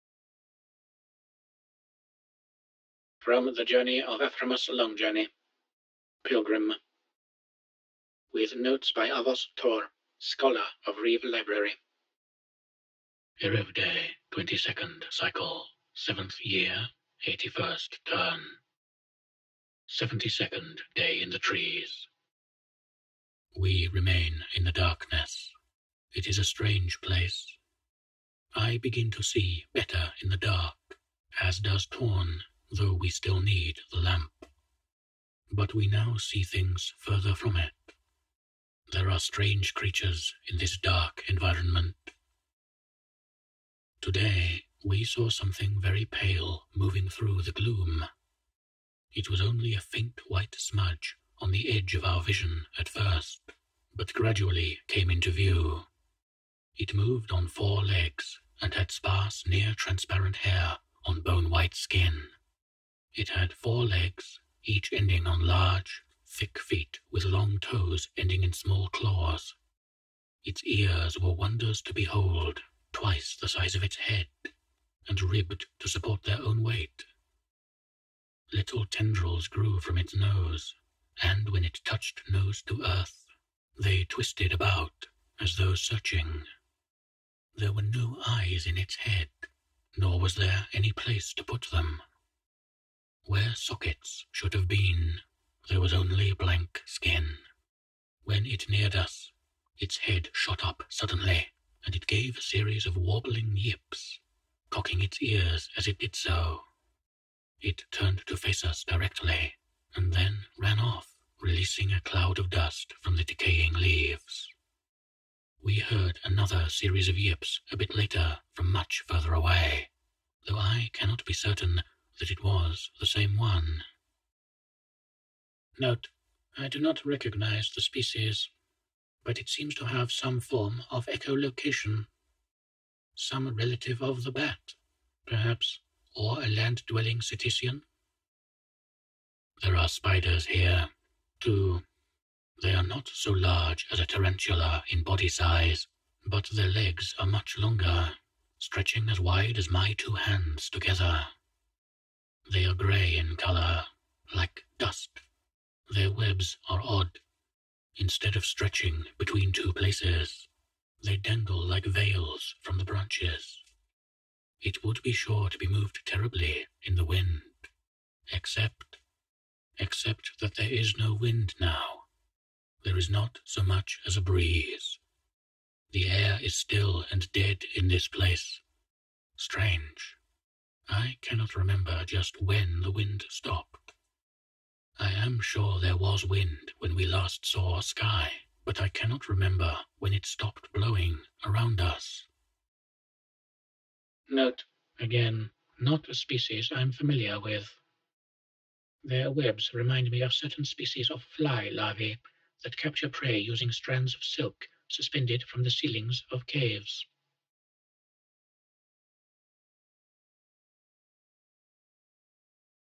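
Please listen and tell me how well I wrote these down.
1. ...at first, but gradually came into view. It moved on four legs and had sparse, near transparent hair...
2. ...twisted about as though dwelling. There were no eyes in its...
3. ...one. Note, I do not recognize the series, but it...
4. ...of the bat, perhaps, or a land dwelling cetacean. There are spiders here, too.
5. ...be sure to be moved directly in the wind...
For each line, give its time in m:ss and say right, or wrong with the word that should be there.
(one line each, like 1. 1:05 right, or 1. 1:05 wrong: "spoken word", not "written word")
1. 0:52 right
2. 1:24 wrong: "searching", not "dwelling"
3. 2:03 wrong: "species", not "series"
4. 2:14 right
5. 2:45 wrong: "terribly", not "directly".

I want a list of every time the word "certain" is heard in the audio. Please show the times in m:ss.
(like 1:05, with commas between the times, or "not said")
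2:01, 3:20.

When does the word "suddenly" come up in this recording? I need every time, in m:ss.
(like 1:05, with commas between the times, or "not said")
1:40.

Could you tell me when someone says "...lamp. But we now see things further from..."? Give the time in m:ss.
0:33.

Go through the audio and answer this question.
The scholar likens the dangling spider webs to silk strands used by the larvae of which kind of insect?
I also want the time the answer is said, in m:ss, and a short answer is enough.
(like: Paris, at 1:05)
fly, at 3:21.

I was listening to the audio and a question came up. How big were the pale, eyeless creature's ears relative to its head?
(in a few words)
twice the size.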